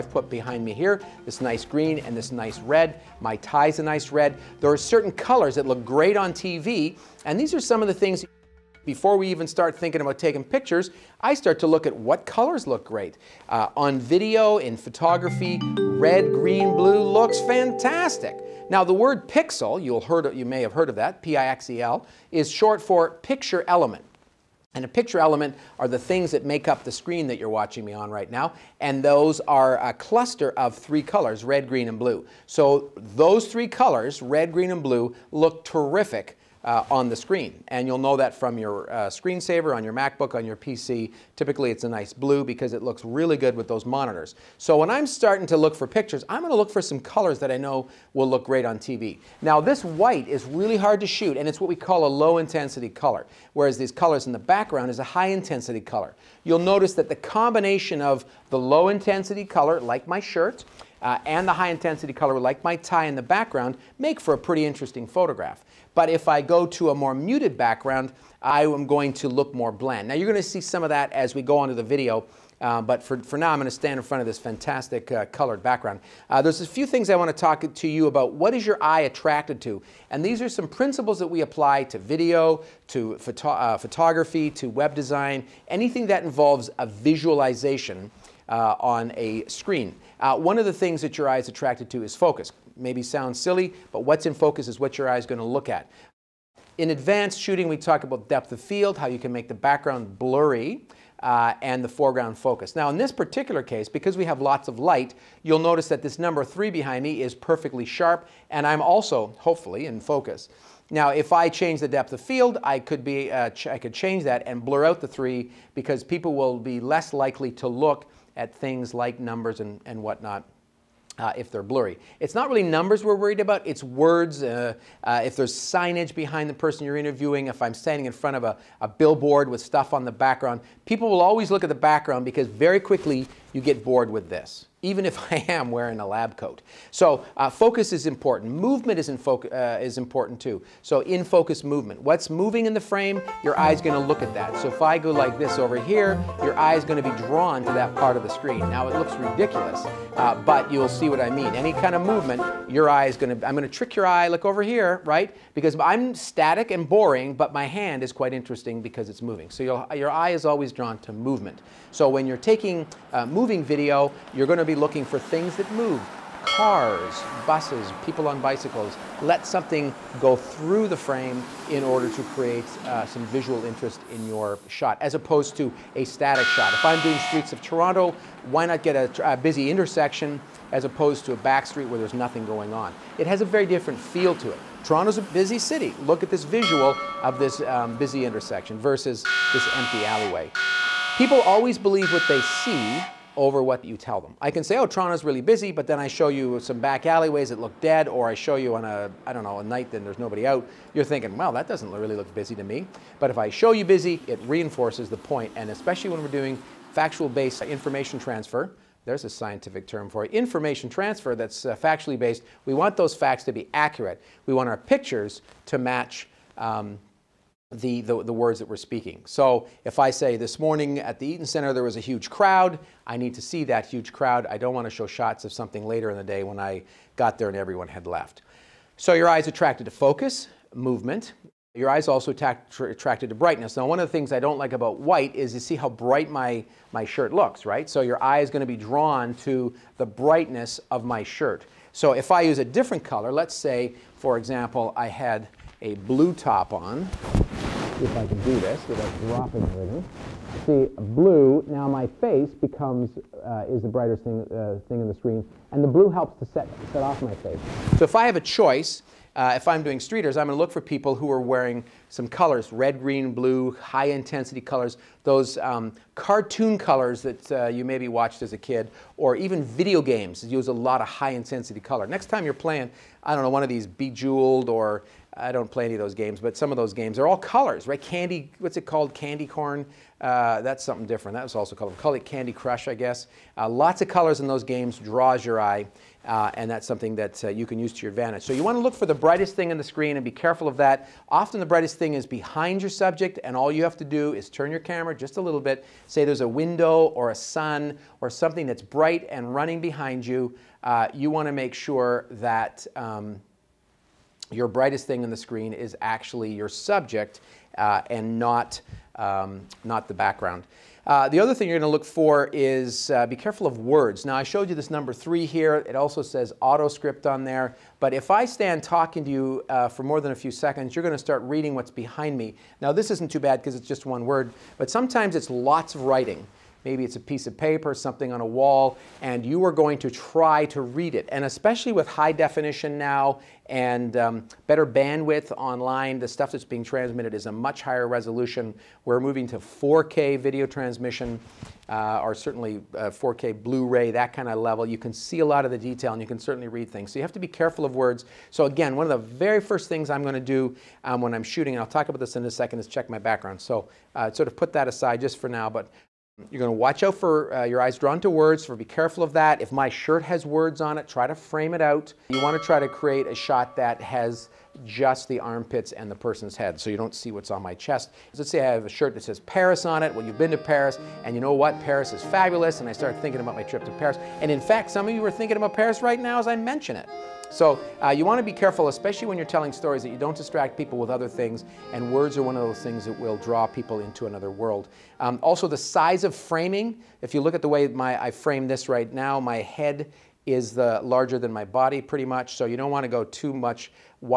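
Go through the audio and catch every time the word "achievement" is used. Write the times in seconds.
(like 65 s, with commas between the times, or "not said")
not said.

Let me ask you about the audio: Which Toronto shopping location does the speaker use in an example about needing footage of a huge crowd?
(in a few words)
Eaton Center.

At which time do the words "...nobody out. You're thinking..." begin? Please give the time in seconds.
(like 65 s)
200 s.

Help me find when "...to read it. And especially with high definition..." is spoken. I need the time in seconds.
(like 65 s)
330 s.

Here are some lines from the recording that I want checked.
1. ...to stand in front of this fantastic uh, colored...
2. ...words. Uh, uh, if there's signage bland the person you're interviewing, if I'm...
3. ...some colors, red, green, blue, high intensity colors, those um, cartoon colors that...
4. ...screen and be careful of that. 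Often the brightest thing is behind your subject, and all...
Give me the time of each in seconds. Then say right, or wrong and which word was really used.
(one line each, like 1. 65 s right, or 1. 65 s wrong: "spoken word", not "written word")
1. 73 s right
2. 123 s wrong: "behind", not "bland"
3. 262 s right
4. 289 s right.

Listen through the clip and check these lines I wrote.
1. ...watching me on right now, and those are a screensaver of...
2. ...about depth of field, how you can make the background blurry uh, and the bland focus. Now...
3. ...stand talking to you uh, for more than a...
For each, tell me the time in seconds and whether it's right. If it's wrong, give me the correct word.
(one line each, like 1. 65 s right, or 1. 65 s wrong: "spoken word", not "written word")
1. 27 s wrong: "cluster", not "screensaver"
2. 98 s wrong: "foreground", not "bland"
3. 318 s right.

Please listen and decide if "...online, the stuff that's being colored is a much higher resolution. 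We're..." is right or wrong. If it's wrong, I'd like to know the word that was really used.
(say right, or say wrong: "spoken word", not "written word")
wrong: "transmitted", not "colored".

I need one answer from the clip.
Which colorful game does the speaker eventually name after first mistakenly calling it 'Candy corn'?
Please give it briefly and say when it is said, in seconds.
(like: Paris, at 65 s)
Candy Crush, at 282 s.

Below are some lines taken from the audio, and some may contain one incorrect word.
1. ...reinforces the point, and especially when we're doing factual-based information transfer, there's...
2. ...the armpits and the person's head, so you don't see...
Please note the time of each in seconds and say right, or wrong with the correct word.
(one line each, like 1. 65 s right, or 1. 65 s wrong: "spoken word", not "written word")
1. 204 s right
2. 365 s right.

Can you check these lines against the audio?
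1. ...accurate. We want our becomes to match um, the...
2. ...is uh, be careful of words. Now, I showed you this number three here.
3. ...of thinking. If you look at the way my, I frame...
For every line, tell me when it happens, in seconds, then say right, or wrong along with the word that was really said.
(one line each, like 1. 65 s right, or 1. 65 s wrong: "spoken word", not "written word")
1. 213 s wrong: "pictures", not "becomes"
2. 312 s right
3. 386 s wrong: "framing", not "thinking".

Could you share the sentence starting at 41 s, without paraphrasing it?
Typically it's a nice blue because it looks really good with those monitors.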